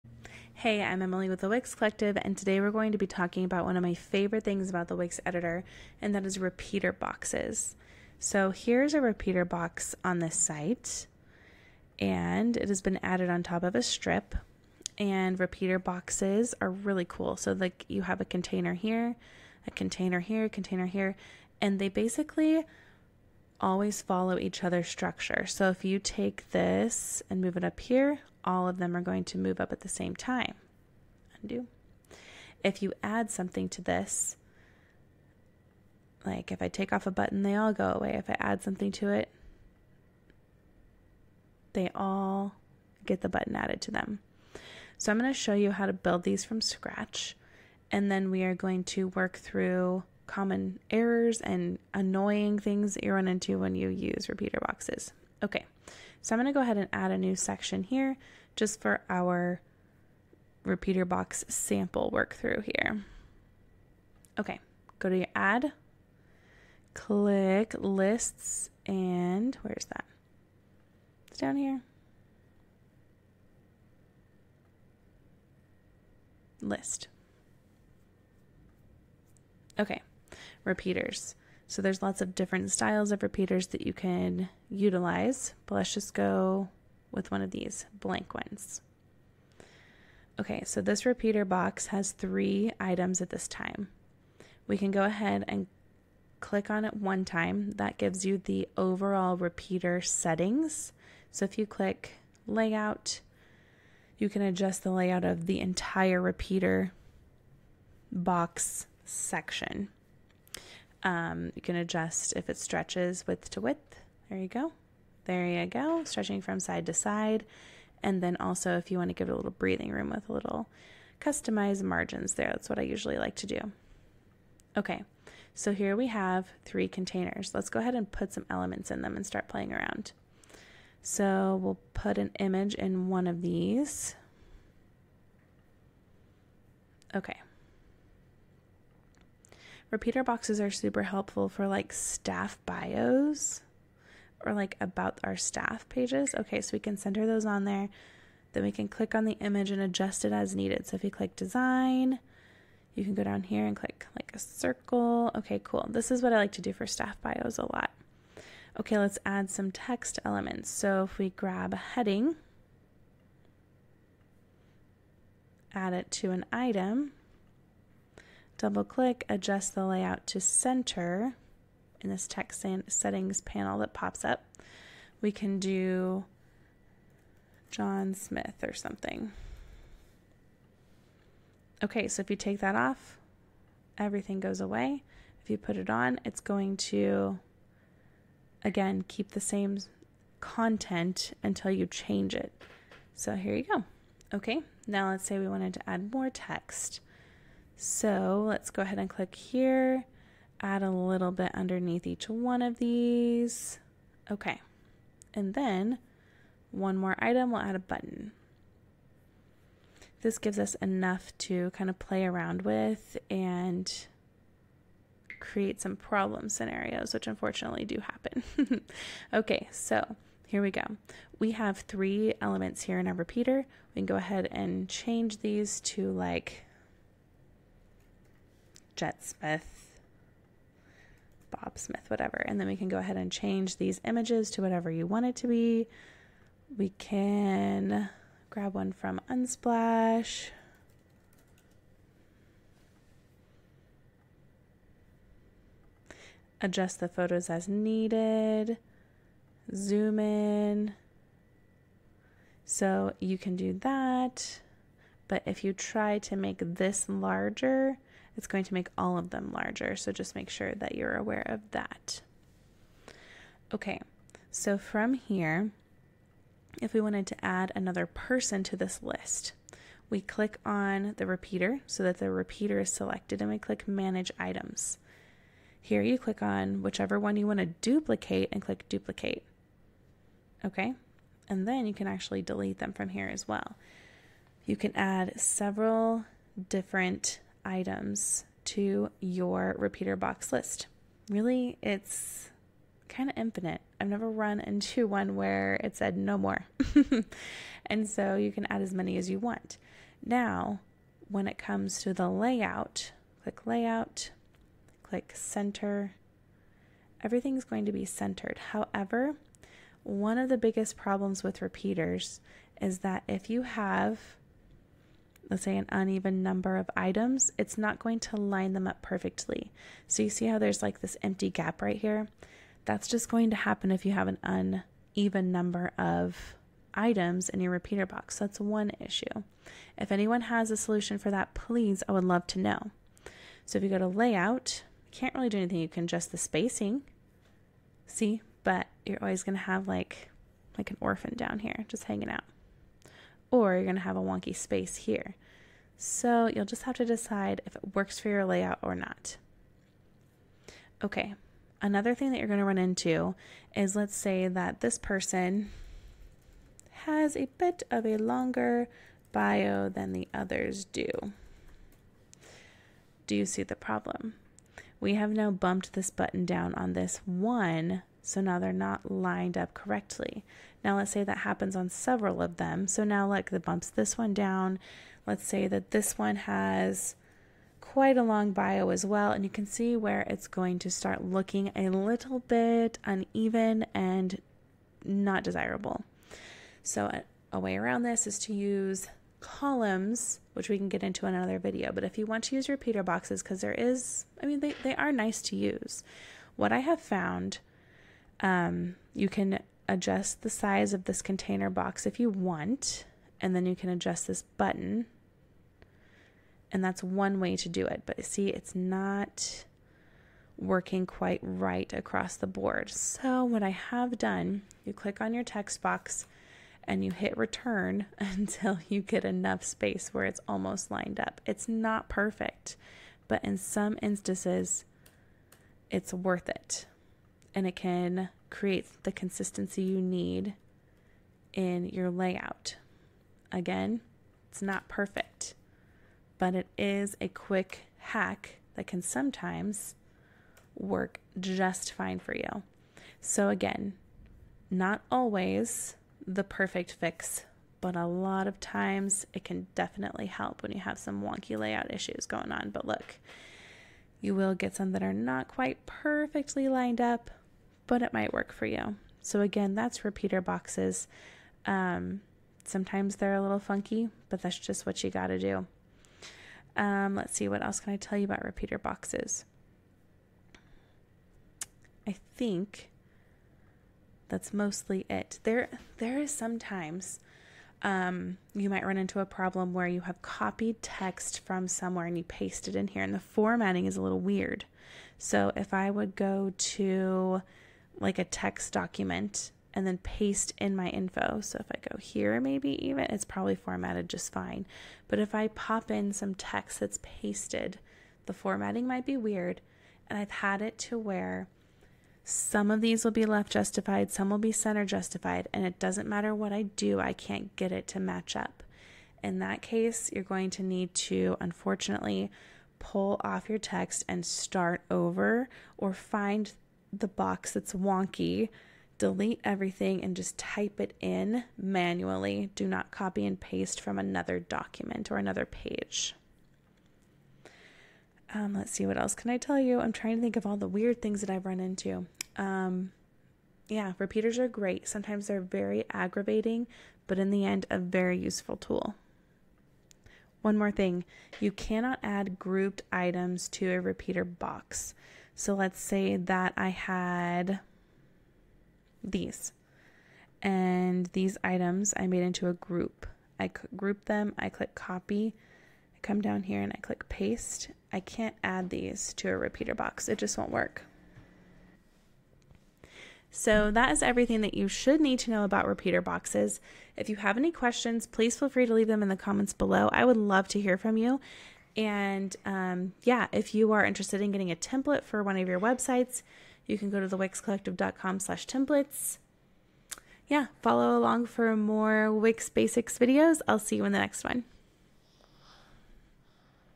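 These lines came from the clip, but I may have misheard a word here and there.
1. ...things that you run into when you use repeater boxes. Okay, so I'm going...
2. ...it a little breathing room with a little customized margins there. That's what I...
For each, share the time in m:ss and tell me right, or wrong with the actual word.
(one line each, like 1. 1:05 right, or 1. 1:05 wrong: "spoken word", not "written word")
1. 0:52 right
2. 1:59 right.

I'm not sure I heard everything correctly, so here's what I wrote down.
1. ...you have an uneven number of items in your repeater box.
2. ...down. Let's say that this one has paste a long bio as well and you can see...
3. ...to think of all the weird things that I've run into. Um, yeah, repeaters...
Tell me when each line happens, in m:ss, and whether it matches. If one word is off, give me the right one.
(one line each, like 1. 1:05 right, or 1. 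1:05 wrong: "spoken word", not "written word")
1. 5:24 right
2. 6:14 wrong: "quite", not "paste"
3. 8:50 right.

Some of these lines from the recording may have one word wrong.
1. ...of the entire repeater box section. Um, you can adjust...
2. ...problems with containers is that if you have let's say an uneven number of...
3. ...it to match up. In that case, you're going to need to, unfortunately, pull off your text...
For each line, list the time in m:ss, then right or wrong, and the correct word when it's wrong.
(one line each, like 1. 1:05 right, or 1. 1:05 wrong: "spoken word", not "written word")
1. 1:45 right
2. 5:10 wrong: "repeaters", not "containers"
3. 8:27 right.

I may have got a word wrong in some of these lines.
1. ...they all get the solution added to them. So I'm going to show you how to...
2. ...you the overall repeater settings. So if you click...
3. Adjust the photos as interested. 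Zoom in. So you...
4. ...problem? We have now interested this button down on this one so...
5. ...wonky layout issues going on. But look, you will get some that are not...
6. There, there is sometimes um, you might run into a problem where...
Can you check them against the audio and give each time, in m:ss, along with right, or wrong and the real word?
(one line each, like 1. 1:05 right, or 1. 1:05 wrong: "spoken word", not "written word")
1. 0:41 wrong: "button", not "solution"
2. 1:38 right
3. 4:06 wrong: "needed", not "interested"
4. 6:03 wrong: "bumped", not "interested"
5. 7:31 right
6. 7:55 right.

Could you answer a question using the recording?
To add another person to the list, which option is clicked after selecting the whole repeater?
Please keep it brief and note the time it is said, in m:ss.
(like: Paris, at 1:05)
Manage items, at 4:33.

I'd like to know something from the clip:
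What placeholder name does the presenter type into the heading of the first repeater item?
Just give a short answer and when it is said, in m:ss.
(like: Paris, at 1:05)
John Smith, at 2:57.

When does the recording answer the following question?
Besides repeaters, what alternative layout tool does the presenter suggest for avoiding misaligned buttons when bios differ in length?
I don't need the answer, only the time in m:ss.
6:29.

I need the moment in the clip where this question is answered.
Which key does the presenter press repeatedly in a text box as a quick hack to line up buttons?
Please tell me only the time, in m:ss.
6:57.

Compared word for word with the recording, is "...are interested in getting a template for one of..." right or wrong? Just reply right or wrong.
right.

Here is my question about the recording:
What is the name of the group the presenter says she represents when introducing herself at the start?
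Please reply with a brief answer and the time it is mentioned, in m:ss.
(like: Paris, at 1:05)
Wix Collective, at 0:01.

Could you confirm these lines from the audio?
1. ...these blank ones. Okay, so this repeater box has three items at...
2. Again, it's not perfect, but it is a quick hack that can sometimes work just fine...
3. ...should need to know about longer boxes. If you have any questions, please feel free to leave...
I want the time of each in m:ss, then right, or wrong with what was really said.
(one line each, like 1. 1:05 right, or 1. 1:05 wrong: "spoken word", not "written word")
1. 1:27 right
2. 7:13 right
3. 9:24 wrong: "repeater", not "longer".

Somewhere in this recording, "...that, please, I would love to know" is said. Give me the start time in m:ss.
5:31.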